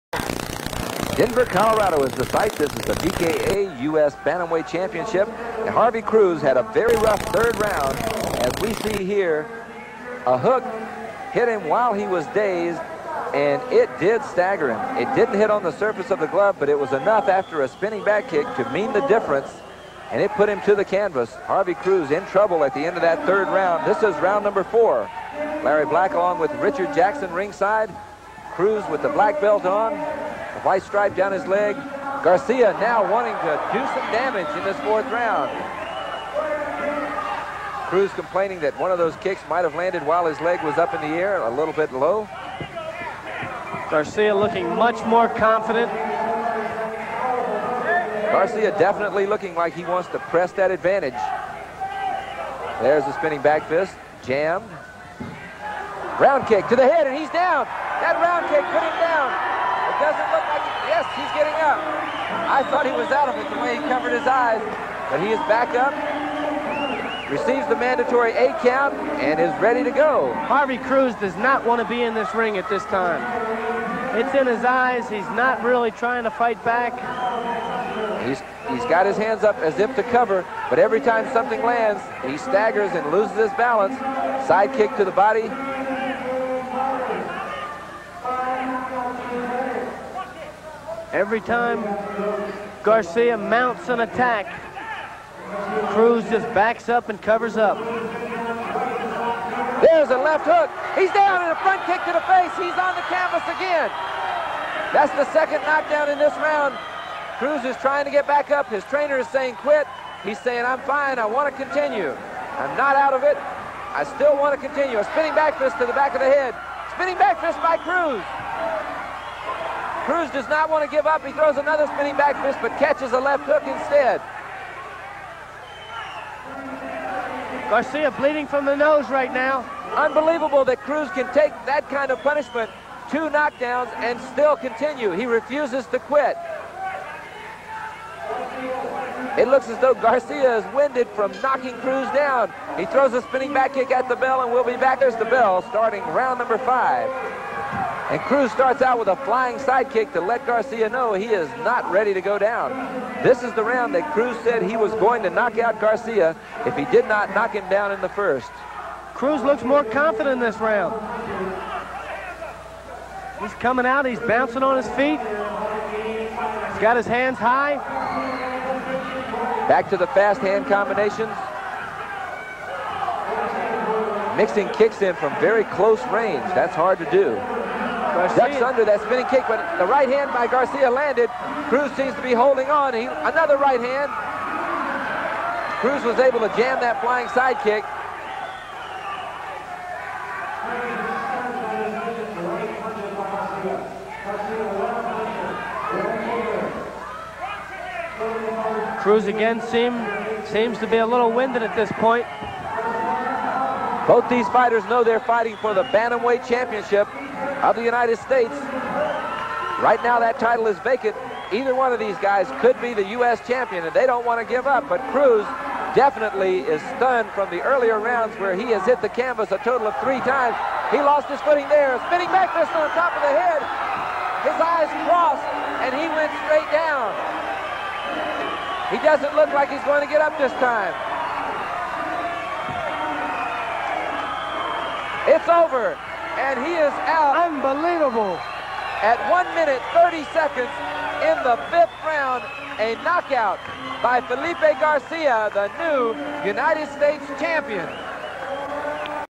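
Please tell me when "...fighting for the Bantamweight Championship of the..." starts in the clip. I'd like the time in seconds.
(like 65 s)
205 s.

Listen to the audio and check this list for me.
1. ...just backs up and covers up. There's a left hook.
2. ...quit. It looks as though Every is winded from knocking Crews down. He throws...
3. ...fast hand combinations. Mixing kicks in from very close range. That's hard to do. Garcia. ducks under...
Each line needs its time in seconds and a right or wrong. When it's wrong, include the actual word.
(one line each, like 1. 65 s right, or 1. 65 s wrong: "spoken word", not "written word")
1. 96 s right
2. 135 s wrong: "Garcia", not "Every"
3. 170 s right.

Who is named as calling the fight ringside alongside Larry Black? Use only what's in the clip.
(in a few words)
Richard Jackson.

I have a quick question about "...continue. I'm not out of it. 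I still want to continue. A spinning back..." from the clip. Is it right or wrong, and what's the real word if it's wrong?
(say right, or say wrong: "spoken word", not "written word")
right.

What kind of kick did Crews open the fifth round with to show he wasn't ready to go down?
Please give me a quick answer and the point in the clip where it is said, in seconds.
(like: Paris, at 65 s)
Flying sidekick, at 149 s.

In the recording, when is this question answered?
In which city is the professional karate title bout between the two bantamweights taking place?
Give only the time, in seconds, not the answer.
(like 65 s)
1 s.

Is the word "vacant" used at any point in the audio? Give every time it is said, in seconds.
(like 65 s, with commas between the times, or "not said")
210 s.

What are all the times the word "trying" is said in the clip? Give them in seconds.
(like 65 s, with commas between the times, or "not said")
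75 s, 107 s.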